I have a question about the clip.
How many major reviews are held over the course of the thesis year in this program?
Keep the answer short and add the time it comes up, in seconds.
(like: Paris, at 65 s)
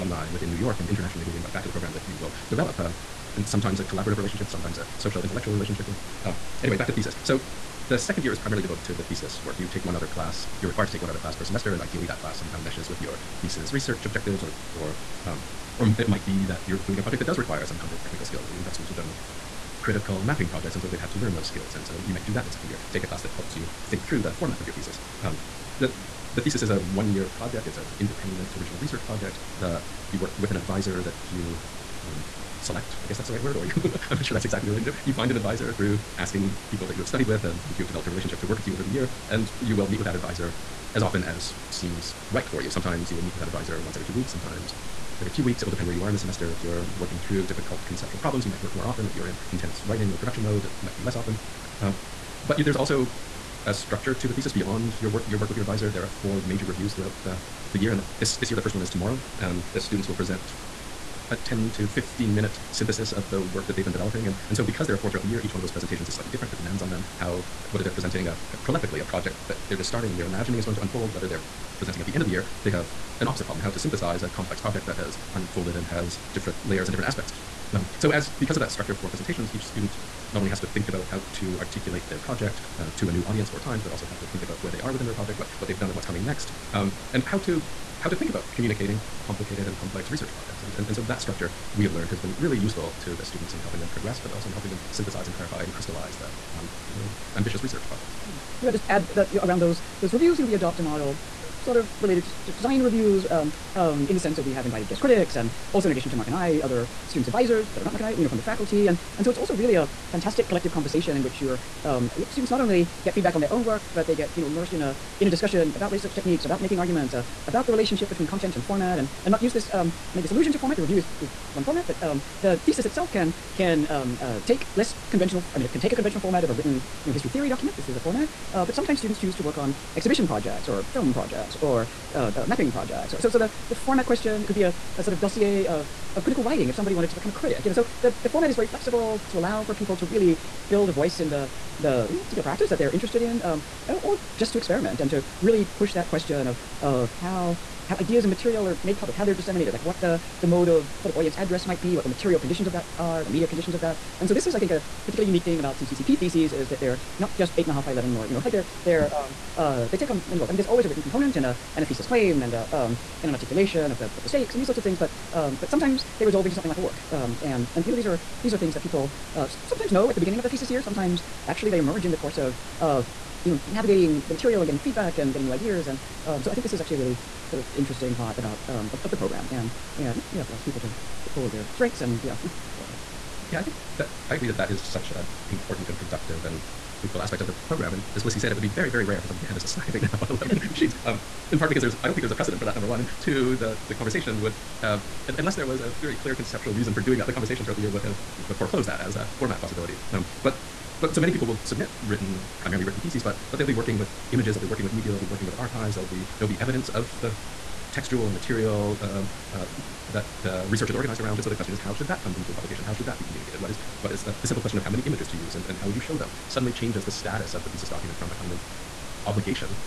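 4, at 56 s.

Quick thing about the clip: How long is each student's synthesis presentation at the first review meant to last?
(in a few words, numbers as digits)
10 to 15 minutes.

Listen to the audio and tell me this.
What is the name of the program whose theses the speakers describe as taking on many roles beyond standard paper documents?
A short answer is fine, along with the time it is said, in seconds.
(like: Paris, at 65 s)
CCCP, at 155 s.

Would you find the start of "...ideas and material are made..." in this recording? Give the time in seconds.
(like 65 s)
147 s.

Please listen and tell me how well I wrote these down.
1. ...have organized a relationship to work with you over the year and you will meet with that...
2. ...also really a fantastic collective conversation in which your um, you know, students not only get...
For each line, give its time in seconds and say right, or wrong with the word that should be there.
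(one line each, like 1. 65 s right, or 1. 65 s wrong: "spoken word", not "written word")
1. 37 s wrong: "developed", not "organized"
2. 109 s right.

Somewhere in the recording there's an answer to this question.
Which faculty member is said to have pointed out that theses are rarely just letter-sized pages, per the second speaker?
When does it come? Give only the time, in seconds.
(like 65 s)
188 s.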